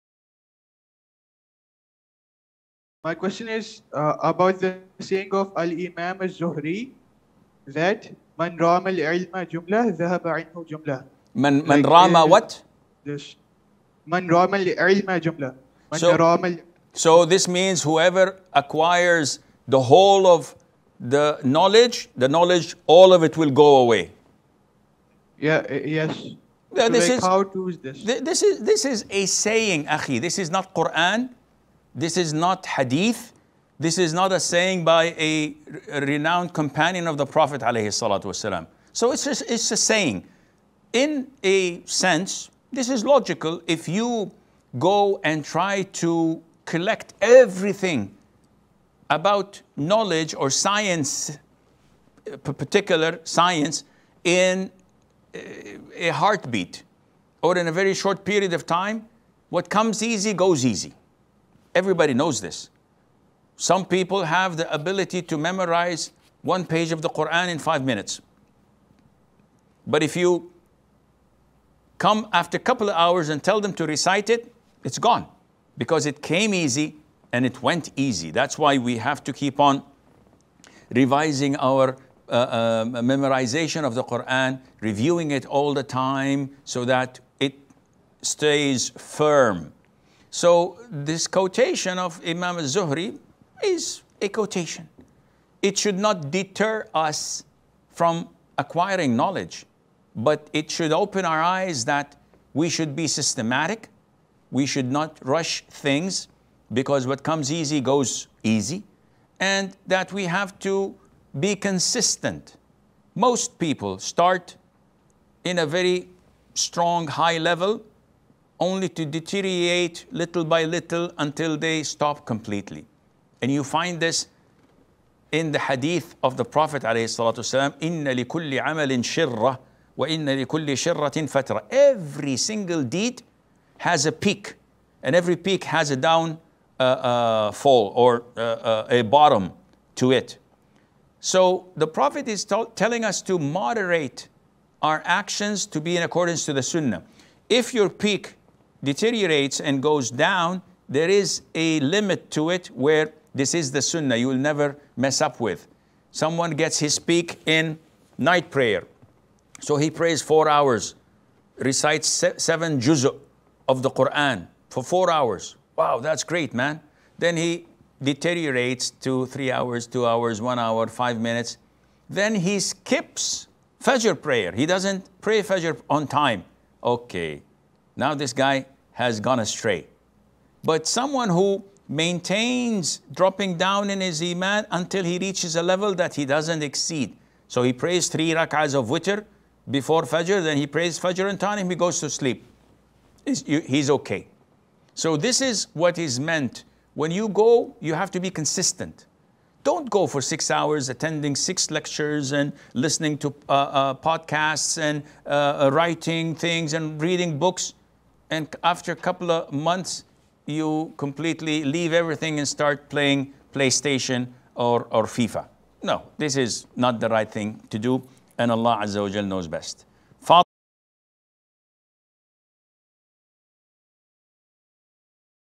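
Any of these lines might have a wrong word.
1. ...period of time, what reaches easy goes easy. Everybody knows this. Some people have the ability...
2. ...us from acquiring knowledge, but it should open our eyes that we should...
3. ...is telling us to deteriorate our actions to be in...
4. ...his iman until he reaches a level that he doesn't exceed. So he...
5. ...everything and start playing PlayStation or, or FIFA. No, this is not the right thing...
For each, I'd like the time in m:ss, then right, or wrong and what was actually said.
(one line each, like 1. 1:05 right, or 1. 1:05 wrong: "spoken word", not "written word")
1. 0:58 wrong: "comes", not "reaches"
2. 1:36 right
3. 2:22 wrong: "moderate", not "deteriorate"
4. 3:04 right
5. 3:31 right.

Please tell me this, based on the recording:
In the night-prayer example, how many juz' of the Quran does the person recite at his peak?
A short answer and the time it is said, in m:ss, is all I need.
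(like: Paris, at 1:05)
7, at 2:42.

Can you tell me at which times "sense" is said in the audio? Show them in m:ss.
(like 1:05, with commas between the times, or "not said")
0:41.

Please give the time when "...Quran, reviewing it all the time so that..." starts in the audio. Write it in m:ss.
1:24.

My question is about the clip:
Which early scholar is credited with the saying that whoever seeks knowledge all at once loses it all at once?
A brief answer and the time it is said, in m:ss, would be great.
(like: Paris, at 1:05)
Al Imam al Zuhri, at 0:05.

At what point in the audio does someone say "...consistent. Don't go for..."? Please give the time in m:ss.
3:18.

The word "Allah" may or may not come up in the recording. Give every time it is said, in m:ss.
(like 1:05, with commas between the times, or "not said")
3:38.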